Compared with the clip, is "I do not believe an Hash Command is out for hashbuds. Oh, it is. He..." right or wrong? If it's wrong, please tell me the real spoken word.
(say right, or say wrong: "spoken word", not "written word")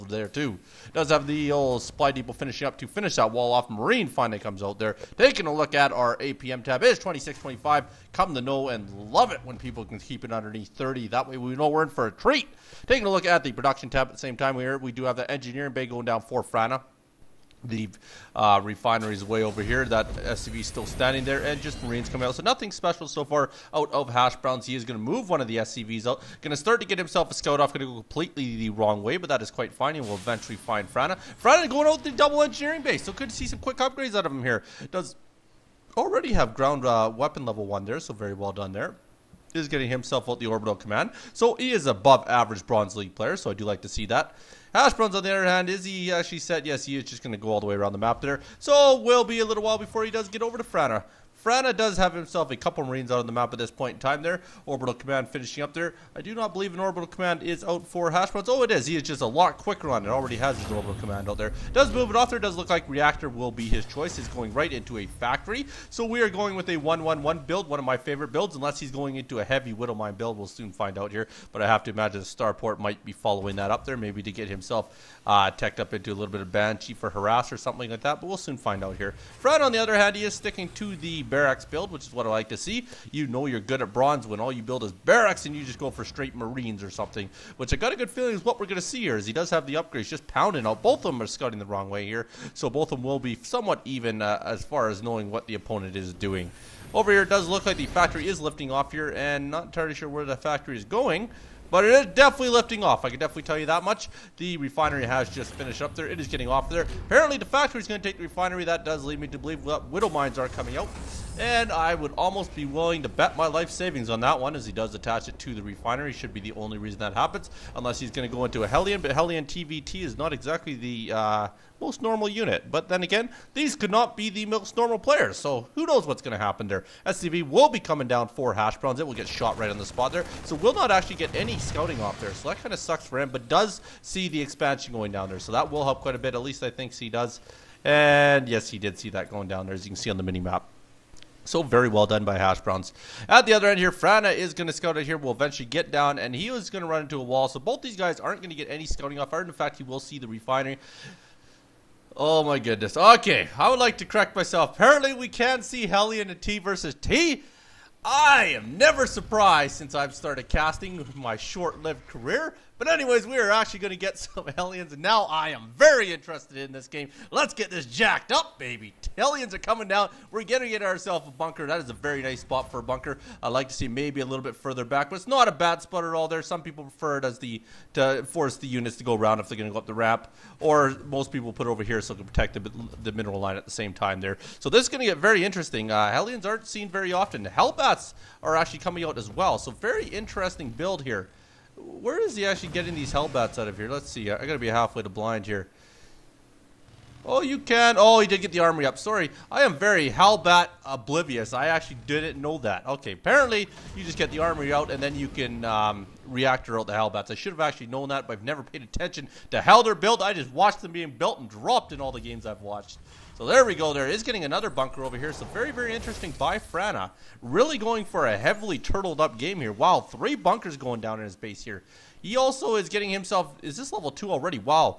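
wrong: "Orbital", not "Hash".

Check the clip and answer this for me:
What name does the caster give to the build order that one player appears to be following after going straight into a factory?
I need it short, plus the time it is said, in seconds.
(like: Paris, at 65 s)
1-1-1 build, at 66 s.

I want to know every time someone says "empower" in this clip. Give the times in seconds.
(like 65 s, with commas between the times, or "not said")
not said.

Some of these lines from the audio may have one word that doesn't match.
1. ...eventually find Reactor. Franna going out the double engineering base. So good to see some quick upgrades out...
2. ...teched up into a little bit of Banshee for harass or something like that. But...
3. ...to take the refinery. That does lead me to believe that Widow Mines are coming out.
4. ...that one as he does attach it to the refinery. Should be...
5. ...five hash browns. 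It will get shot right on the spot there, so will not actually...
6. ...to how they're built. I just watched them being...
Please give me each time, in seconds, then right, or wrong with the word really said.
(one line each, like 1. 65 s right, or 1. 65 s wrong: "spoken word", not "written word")
1. 30 s wrong: "Franna", not "Reactor"
2. 75 s right
3. 107 s right
4. 114 s right
5. 128 s wrong: "four", not "five"
6. 209 s right.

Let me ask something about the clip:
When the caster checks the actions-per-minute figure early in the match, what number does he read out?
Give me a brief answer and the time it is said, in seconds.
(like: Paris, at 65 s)
26.25, at 6 s.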